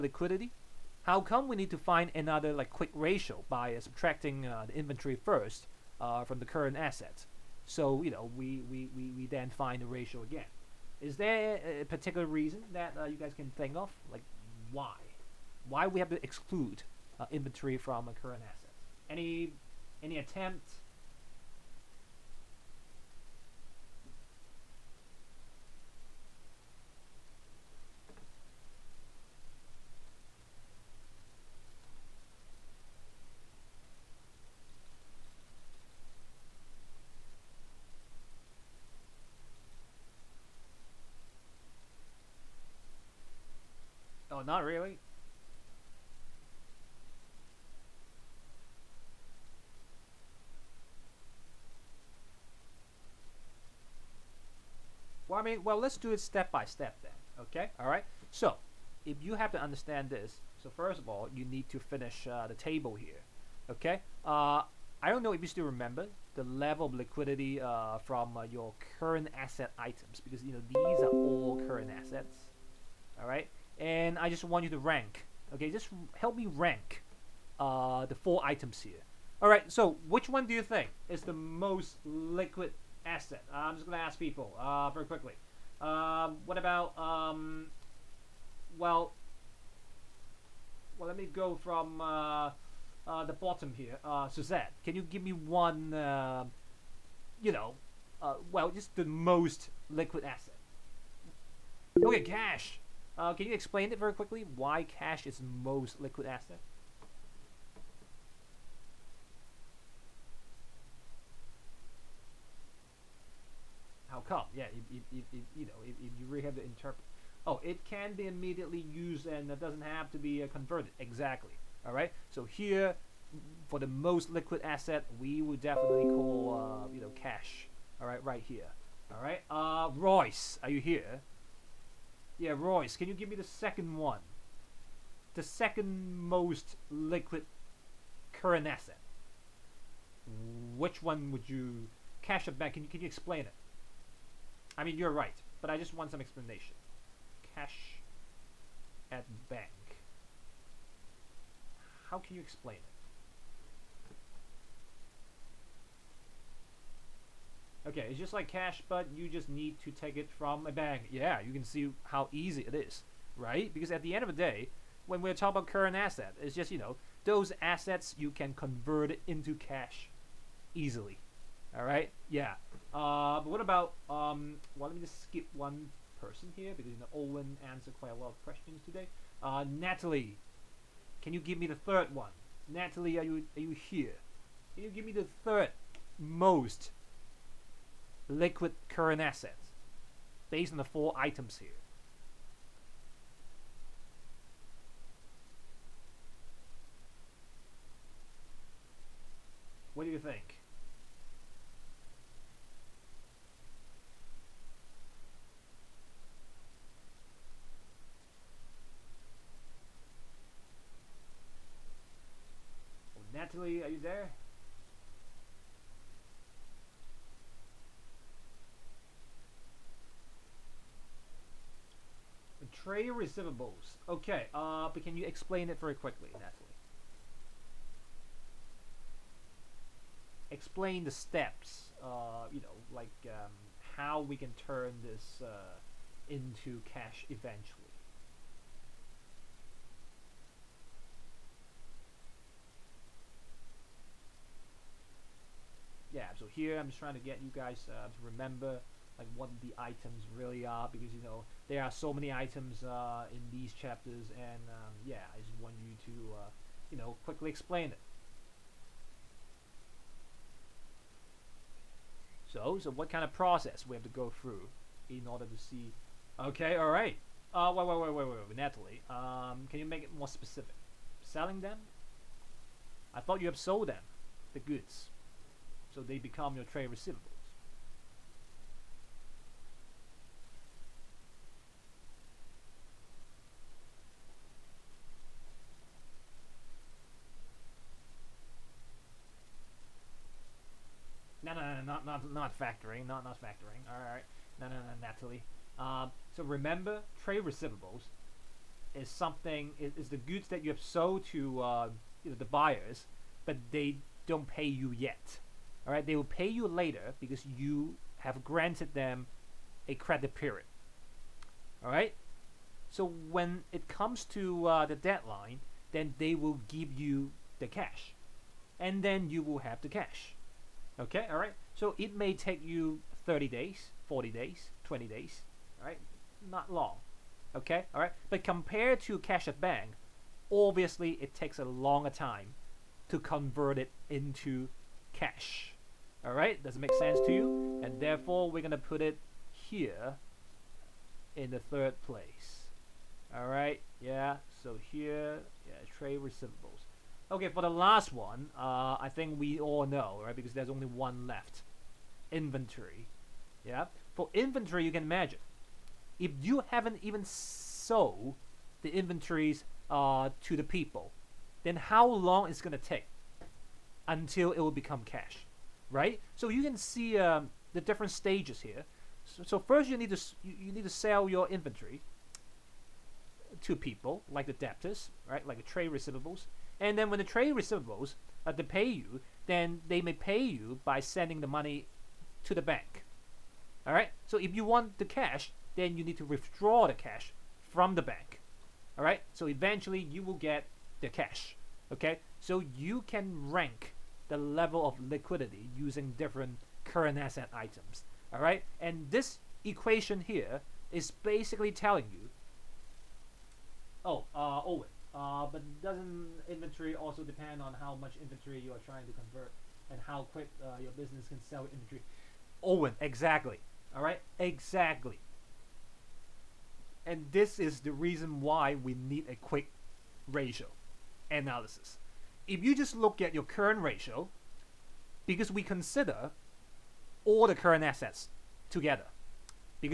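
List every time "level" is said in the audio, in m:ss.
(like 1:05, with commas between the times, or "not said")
1:06, 6:34.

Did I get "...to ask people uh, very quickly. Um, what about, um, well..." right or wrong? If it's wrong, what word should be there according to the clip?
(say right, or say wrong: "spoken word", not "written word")
right.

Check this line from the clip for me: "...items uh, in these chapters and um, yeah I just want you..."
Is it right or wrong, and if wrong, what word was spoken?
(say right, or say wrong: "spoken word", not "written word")
right.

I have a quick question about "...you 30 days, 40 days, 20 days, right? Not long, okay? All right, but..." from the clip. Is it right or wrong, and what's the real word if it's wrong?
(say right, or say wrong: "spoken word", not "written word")
right.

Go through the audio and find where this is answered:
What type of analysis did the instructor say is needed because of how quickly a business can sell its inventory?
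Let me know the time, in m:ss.
6:59.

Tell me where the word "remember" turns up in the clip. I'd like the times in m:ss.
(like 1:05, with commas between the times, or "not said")
1:05, 4:08, 4:56.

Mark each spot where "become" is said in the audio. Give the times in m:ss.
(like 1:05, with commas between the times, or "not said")
4:36, 6:04.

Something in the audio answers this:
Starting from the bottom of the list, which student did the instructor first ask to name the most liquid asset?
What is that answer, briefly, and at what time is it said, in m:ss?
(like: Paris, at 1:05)
Suzette, at 1:34.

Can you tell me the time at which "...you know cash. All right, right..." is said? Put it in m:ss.
2:06.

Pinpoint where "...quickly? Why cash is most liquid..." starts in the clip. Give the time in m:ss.
1:44.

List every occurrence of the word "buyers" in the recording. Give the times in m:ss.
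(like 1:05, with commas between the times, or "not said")
5:02.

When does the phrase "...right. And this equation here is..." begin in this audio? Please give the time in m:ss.
6:38.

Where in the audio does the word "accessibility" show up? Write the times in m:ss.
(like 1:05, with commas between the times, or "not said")
not said.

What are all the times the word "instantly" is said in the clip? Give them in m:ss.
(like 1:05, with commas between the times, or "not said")
not said.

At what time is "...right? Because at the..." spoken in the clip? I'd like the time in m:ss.
2:43.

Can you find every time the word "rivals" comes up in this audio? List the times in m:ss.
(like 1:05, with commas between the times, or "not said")
not said.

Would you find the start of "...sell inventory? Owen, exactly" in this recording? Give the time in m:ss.
6:51.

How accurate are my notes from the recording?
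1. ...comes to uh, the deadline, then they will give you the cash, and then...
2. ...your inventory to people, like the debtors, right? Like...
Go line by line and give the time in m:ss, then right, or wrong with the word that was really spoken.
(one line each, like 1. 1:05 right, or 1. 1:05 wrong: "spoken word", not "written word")
1. 5:13 right
2. 6:11 right.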